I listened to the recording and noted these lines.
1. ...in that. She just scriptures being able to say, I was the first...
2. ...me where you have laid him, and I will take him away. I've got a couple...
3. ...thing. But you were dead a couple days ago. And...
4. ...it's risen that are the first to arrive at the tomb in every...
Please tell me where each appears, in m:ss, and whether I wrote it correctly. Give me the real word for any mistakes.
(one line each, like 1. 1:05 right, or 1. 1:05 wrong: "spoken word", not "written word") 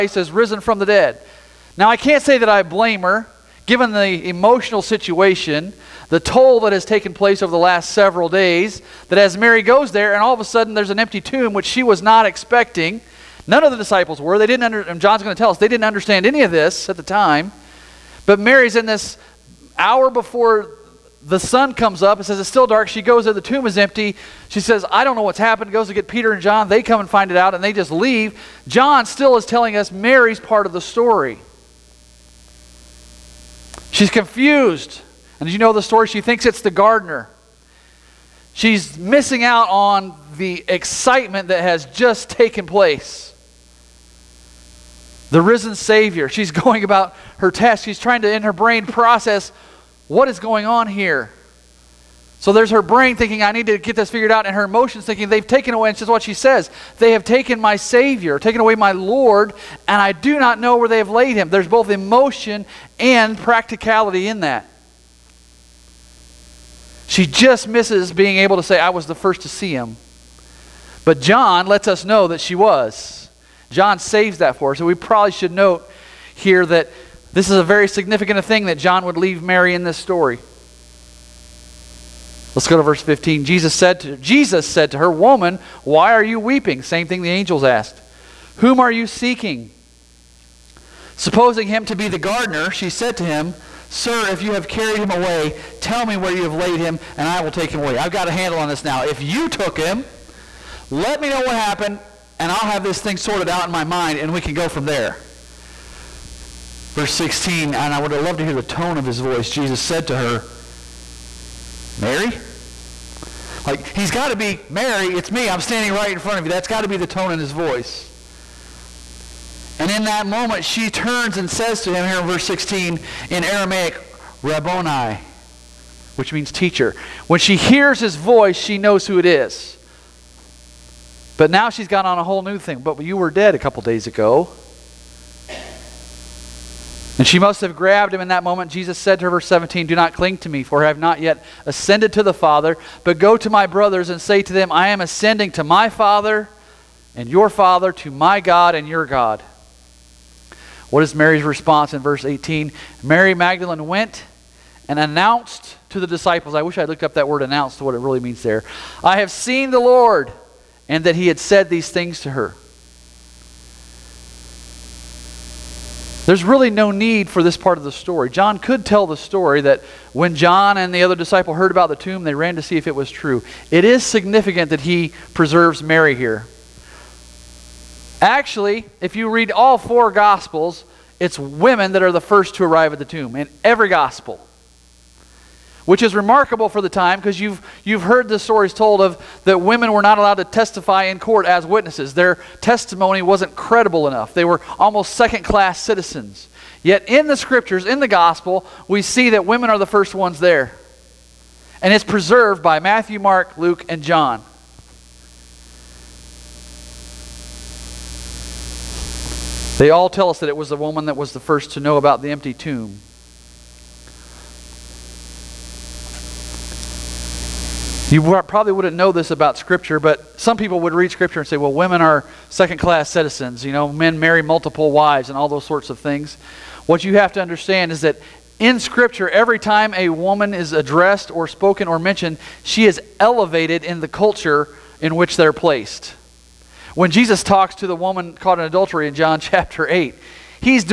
1. 1:04 wrong: "misses", not "scriptures"
2. 1:36 wrong: "handle", not "couple"
3. 2:12 right
4. 3:01 wrong: "women", not "risen".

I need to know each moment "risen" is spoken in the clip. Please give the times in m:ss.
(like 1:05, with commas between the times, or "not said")
0:00, 0:45.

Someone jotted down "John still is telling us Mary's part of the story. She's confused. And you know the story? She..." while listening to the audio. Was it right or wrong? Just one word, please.
right.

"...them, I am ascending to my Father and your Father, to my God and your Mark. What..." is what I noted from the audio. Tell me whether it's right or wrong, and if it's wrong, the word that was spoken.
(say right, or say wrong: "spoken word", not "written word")
wrong: "God", not "Mark".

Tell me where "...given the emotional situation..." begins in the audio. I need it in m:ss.
0:03.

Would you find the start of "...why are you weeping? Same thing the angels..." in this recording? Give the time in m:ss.
1:25.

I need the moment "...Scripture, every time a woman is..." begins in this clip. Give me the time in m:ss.
3:48.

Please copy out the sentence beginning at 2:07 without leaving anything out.
When she hears his voice, she knows who it is.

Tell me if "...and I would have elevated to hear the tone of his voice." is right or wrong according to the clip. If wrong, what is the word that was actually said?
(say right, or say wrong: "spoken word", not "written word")
wrong: "loved", not "elevated".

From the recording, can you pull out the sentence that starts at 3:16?
Yet in the scriptures, in the gospel, we see that women are the first ones there.